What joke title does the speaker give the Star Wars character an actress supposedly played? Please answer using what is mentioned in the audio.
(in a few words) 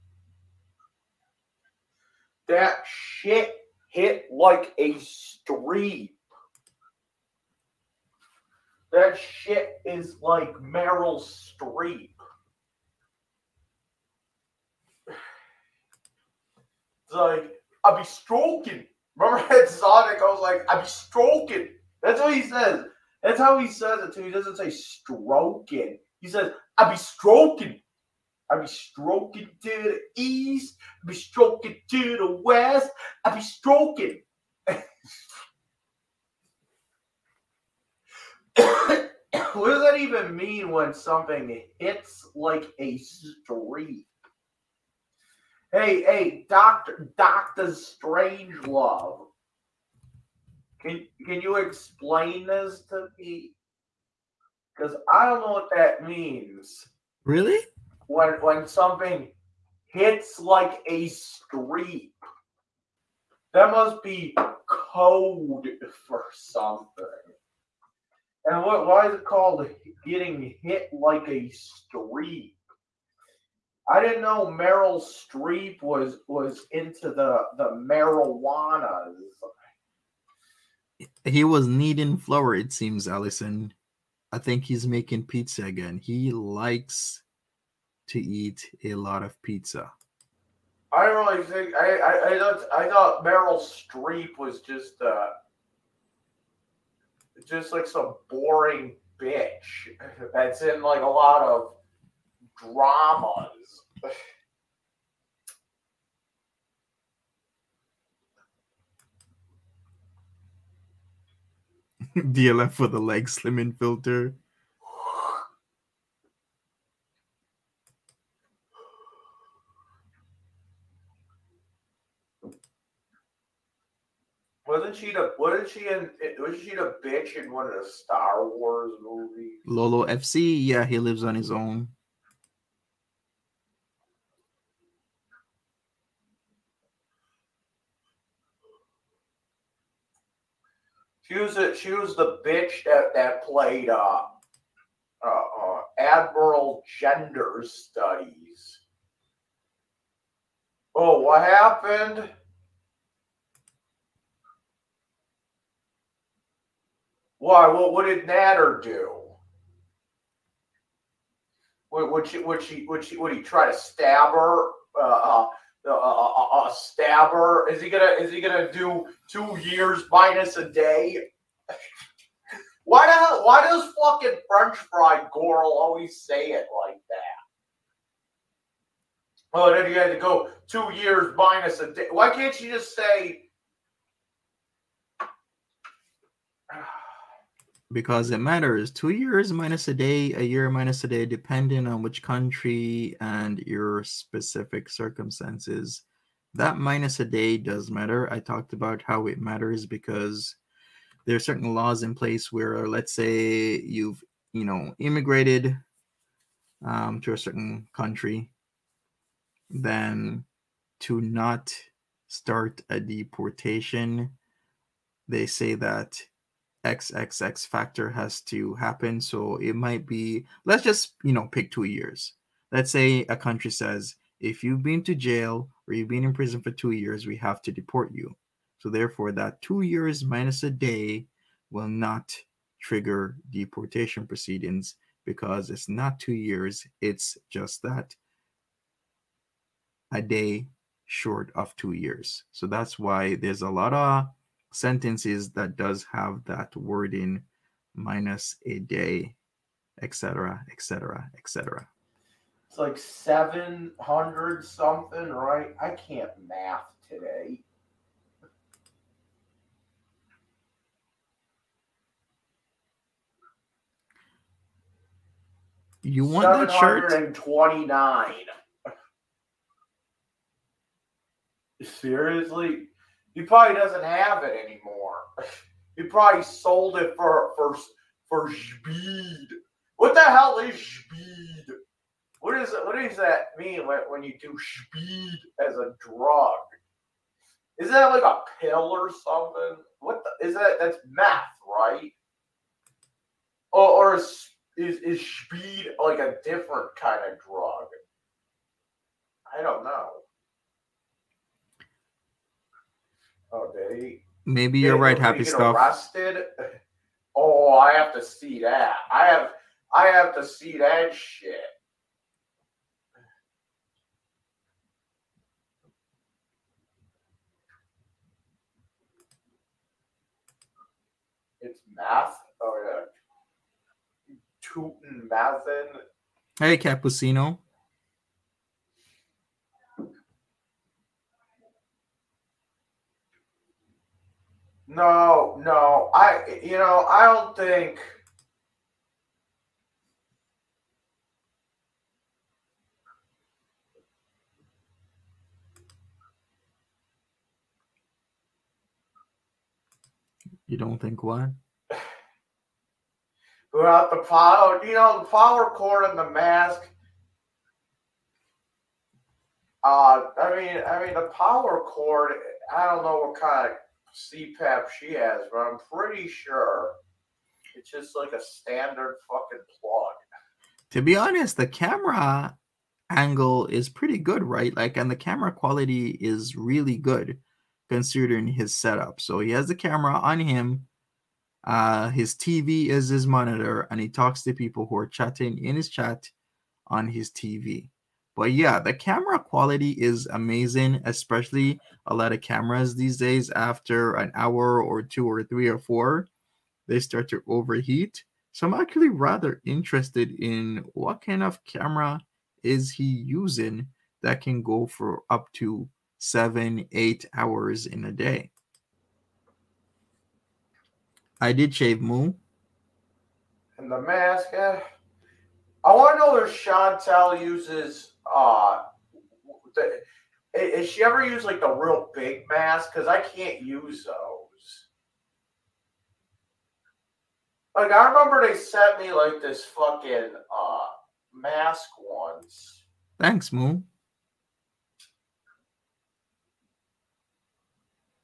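Admiral Gender Studies.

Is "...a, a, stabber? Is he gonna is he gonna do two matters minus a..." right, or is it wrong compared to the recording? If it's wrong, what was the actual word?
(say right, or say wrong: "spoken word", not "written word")
wrong: "years", not "matters".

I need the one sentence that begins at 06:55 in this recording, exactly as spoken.
I want to know if Chantal uses uh, the, is she ever use like the real big mask?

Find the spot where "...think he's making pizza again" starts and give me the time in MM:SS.
01:24.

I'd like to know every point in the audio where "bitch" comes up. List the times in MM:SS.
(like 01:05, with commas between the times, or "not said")
01:39, 02:07, 02:22.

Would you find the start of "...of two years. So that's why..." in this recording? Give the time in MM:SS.
04:01.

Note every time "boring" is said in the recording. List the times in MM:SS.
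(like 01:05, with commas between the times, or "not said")
01:38.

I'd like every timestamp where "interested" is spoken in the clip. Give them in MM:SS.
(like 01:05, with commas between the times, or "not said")
06:39.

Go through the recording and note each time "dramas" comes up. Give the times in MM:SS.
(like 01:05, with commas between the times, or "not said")
01:42.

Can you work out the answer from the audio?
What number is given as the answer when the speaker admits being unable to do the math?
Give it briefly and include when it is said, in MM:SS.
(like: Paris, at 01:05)
729, at 04:27.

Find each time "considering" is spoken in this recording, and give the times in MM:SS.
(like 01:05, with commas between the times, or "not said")
06:17.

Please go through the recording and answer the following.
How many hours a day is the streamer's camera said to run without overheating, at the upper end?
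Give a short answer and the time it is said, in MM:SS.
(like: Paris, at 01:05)
8, at 06:46.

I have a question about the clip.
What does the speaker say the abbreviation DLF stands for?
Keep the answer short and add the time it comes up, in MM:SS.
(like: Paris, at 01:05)
leg slimming filter, at 01:52.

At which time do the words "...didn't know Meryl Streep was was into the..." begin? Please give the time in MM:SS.
01:14.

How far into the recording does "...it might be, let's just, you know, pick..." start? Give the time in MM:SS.
03:39.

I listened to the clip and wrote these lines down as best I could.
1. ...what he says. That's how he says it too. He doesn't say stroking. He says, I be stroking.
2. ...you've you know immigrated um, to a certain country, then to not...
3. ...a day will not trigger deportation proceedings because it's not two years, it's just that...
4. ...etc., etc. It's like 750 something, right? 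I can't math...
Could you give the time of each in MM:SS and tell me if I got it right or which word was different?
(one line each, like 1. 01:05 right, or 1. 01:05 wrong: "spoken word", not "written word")
1. 00:22 right
2. 03:23 right
3. 03:50 right
4. 04:10 wrong: "700", not "750".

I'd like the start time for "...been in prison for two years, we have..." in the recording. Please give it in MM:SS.
03:46.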